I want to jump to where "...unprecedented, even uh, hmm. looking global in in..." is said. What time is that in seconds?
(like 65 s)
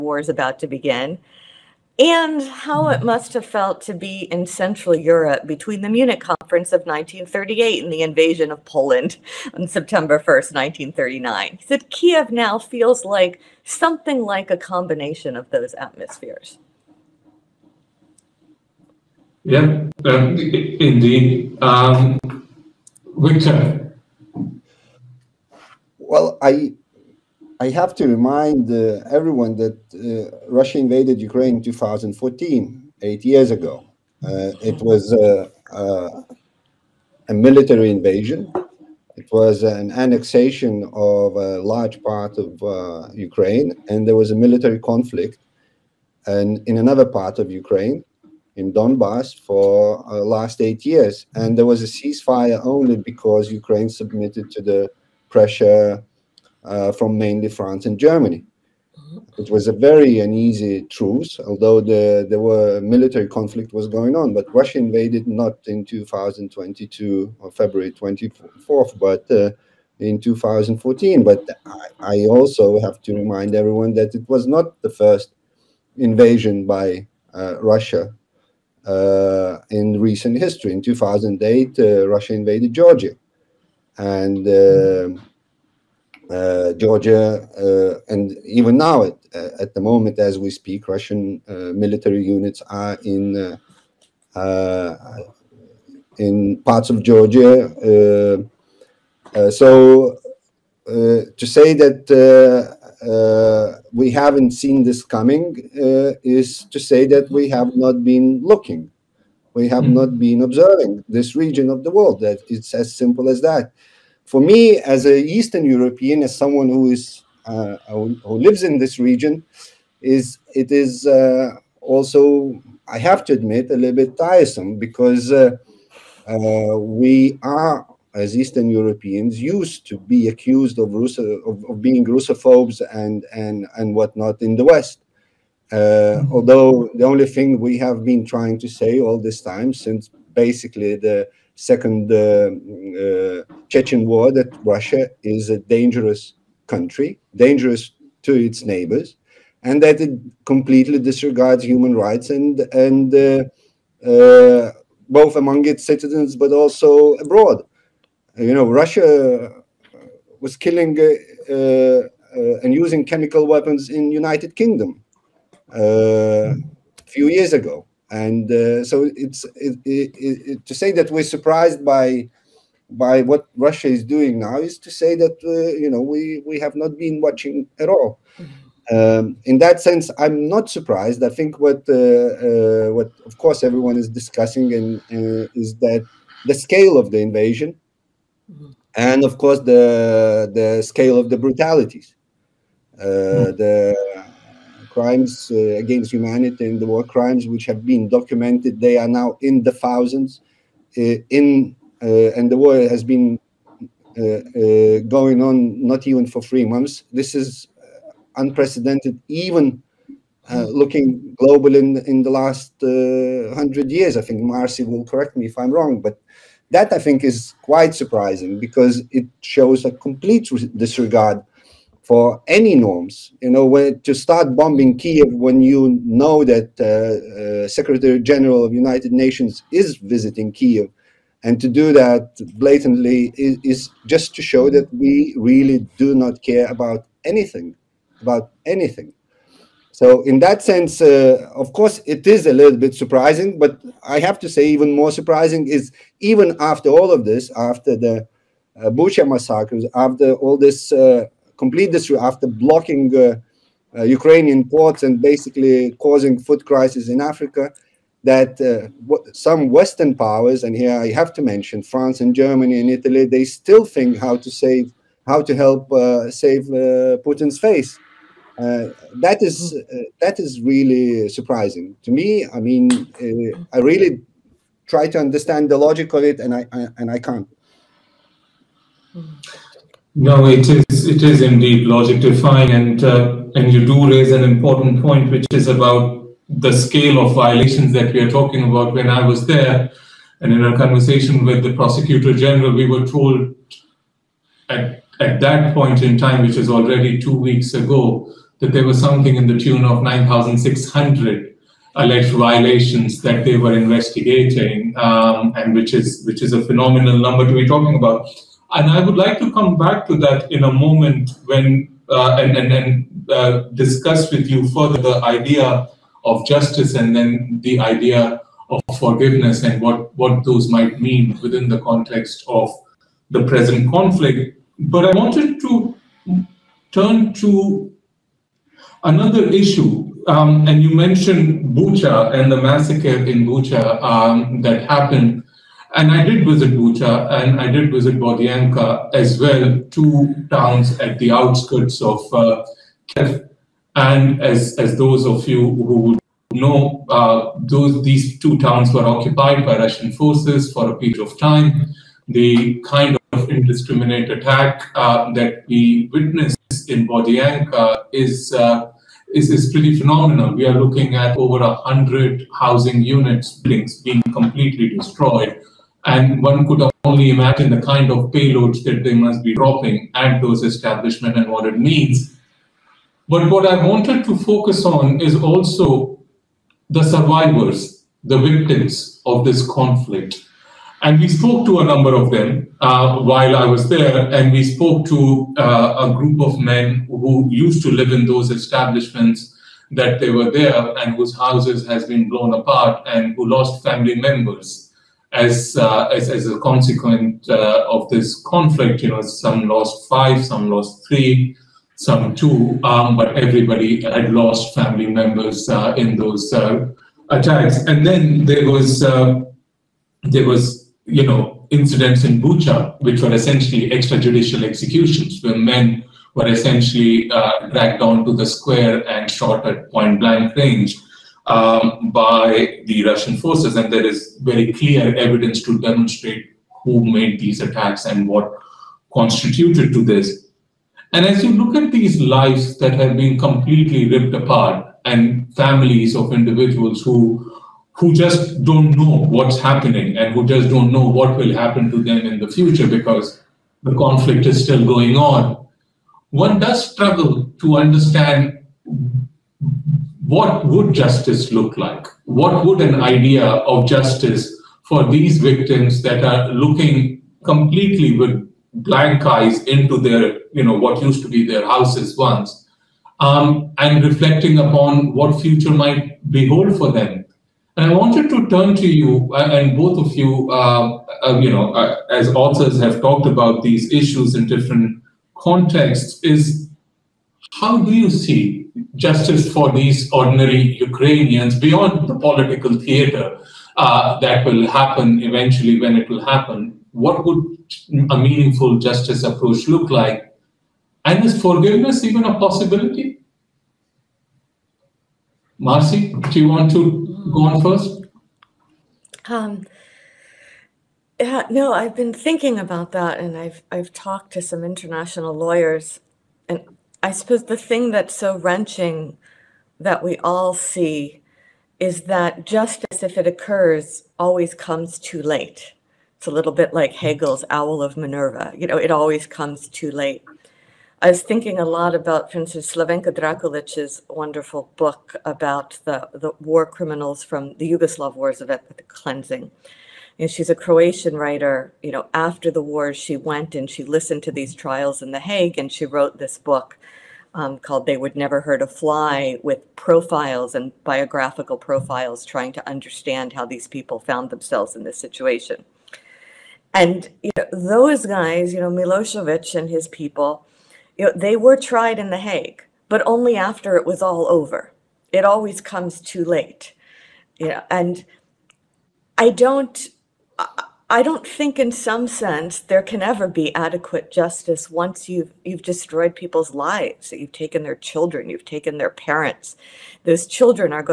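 208 s.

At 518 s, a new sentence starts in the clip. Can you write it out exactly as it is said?
You know, it always comes too late.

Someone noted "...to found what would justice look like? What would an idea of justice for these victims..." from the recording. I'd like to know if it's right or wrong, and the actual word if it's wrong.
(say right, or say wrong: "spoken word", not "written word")
wrong: "understand", not "found".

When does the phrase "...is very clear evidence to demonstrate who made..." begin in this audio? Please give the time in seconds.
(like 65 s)
424 s.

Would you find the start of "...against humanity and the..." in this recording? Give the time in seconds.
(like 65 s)
195 s.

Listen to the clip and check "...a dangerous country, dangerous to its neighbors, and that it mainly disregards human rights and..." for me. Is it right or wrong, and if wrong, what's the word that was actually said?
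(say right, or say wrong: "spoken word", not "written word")
wrong: "completely", not "mainly".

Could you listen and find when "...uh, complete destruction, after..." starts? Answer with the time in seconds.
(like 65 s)
250 s.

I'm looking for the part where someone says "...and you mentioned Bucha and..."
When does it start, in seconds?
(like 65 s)
330 s.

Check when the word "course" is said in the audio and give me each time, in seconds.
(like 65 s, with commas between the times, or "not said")
183 s, 189 s, 241 s.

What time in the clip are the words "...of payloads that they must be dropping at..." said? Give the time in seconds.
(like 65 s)
368 s.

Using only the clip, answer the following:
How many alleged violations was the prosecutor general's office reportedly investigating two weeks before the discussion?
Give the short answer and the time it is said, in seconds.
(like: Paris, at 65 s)
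9,600, at 300 s.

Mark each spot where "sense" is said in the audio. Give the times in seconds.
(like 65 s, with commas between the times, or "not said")
179 s, 240 s, 562 s.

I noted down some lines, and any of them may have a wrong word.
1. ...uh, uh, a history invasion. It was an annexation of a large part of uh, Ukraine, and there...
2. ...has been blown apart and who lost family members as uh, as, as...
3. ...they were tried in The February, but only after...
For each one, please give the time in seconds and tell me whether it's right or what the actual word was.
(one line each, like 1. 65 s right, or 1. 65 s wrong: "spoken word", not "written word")
1. 35 s wrong: "military", not "history"
2. 391 s right
3. 551 s wrong: "Hague", not "February".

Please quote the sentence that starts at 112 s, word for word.
That it's as simple as that.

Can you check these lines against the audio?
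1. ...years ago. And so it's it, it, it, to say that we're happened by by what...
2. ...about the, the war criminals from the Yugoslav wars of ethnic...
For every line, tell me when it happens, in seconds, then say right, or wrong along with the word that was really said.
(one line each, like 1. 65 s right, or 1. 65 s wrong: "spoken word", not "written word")
1. 167 s wrong: "surprised", not "happened"
2. 525 s right.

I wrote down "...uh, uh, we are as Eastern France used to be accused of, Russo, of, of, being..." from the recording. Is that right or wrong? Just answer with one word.
wrong.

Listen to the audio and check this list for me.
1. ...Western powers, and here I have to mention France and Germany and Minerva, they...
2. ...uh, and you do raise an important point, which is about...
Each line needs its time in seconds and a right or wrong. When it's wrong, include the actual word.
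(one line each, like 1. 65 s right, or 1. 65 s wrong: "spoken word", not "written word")
1. 259 s wrong: "Italy", not "Minerva"
2. 283 s right.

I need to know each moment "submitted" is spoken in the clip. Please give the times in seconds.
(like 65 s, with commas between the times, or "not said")
53 s.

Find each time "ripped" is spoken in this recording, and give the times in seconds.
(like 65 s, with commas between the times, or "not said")
434 s.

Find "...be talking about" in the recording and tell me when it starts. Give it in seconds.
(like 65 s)
307 s.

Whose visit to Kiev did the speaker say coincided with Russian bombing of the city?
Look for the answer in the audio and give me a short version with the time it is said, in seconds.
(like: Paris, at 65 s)
Secretary General of United Nations, at 227 s.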